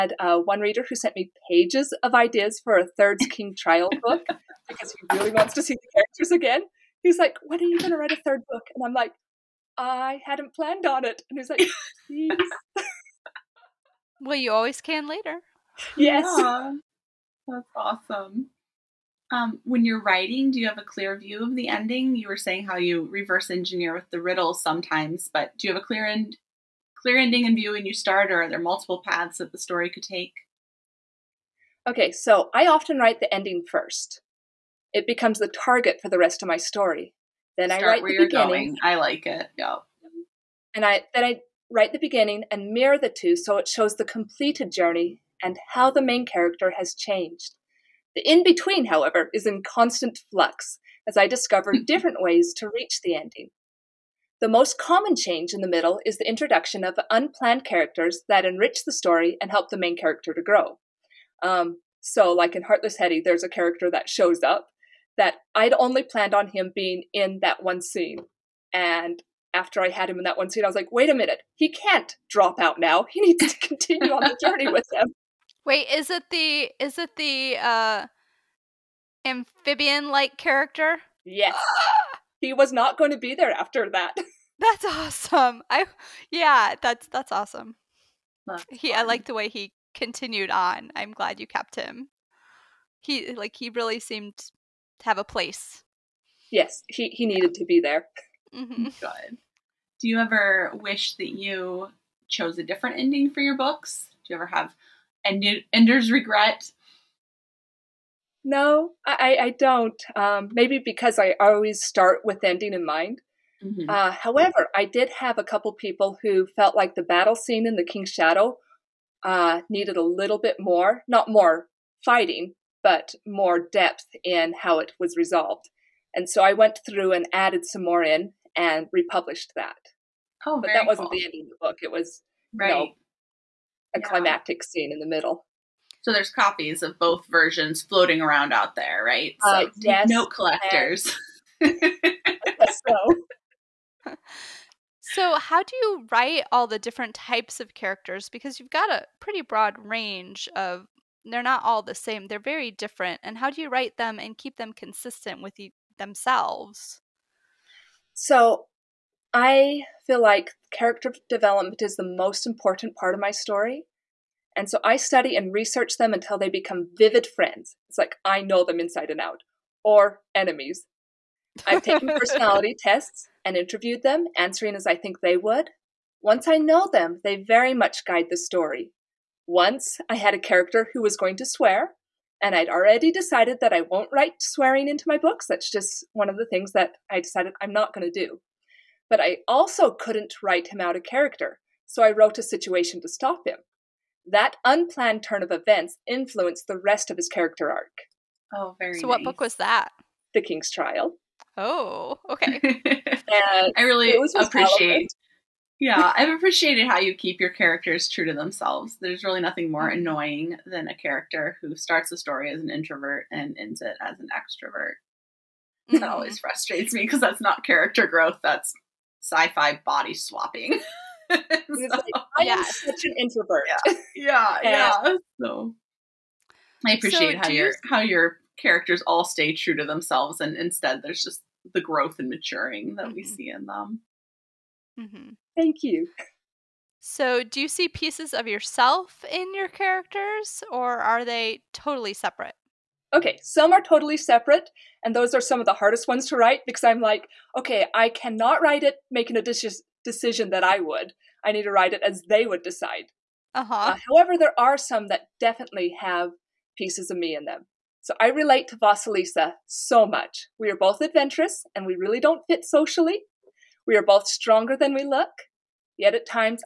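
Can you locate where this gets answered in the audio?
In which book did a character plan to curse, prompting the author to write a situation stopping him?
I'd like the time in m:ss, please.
3:20.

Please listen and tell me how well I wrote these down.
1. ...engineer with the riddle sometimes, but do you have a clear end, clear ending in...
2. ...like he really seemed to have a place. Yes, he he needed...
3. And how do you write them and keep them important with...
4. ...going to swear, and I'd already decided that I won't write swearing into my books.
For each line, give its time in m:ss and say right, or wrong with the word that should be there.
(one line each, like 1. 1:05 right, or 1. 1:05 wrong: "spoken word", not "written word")
1. 0:23 right
2. 1:33 right
3. 2:33 wrong: "consistent", not "important"
4. 3:01 right.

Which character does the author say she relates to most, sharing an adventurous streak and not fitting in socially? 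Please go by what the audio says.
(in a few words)
Vasilisa.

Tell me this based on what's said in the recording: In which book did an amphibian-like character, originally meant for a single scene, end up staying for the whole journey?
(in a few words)
Heartless Hette.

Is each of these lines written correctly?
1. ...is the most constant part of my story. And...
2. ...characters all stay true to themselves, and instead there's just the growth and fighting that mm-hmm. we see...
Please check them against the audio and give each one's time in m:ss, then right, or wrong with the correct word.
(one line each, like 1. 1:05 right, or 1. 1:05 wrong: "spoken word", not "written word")
1. 2:41 wrong: "important", not "constant"
2. 3:48 wrong: "maturing", not "fighting".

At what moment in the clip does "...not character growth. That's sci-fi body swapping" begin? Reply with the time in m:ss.
3:37.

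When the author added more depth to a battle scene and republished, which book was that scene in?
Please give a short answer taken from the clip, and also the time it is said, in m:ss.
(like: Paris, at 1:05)
The King's Shadow, at 1:57.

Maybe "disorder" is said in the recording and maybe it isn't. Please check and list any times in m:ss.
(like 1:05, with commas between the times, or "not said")
not said.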